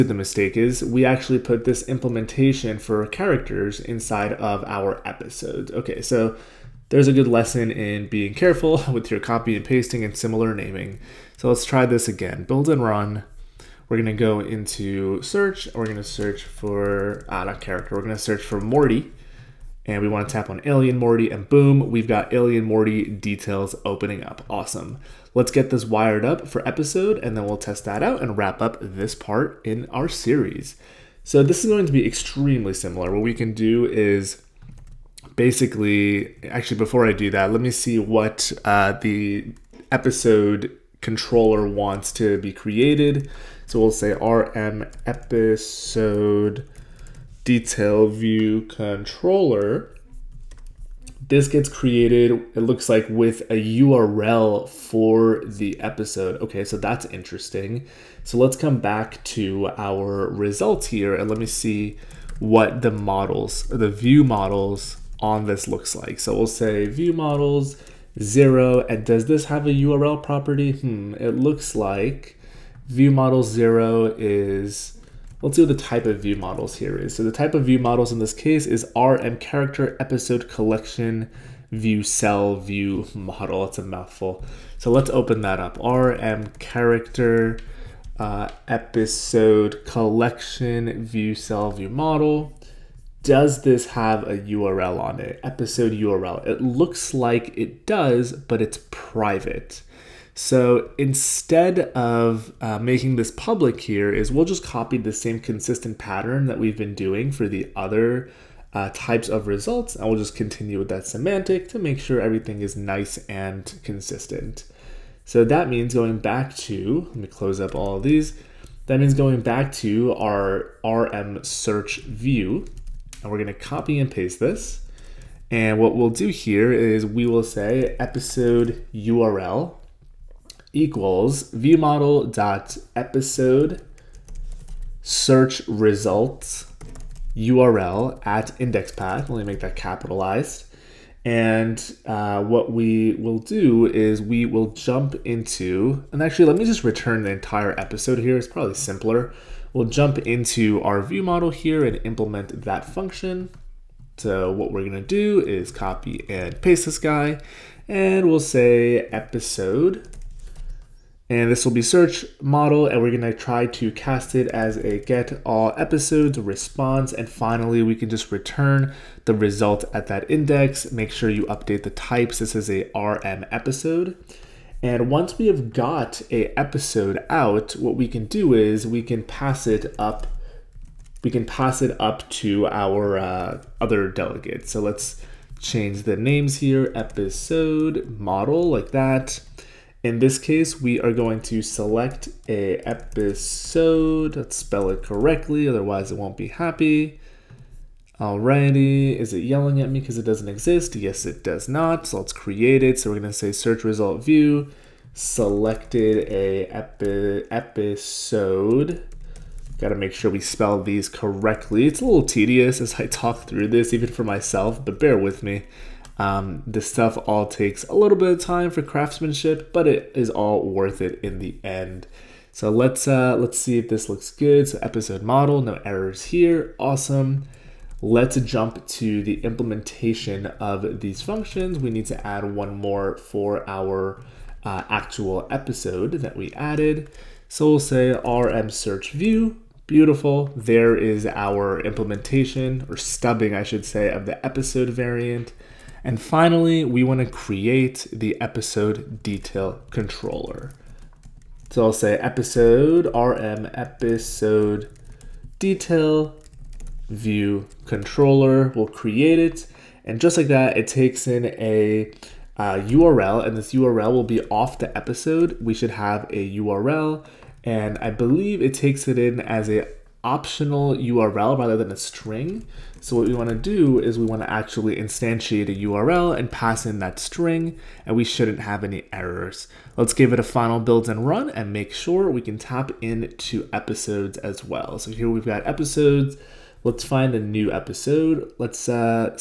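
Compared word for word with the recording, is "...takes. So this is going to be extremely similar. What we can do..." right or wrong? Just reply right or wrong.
wrong.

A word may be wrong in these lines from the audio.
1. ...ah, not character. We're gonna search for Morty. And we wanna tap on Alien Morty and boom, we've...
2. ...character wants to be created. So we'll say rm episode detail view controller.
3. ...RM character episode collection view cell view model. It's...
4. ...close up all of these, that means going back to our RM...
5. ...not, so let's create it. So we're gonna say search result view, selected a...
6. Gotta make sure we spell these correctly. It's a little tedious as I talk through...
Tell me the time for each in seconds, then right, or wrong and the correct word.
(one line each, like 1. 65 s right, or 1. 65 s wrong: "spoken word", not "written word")
1. 17 s right
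2. 41 s wrong: "controller", not "character"
3. 78 s right
4. 117 s right
5. 201 s right
6. 209 s right.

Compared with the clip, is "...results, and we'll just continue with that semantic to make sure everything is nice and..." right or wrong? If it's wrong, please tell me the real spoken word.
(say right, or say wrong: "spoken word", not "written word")
right.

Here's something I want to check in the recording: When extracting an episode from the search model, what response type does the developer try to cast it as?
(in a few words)
get all episodes response.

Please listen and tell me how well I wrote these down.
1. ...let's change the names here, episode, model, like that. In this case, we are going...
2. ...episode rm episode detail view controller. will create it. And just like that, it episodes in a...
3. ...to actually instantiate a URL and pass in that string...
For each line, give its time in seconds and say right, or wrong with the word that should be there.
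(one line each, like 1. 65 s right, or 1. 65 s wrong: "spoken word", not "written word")
1. 184 s right
2. 252 s wrong: "takes", not "episodes"
3. 274 s right.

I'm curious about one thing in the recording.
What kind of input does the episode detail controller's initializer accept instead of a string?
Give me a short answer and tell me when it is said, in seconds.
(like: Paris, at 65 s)
optional URL, at 270 s.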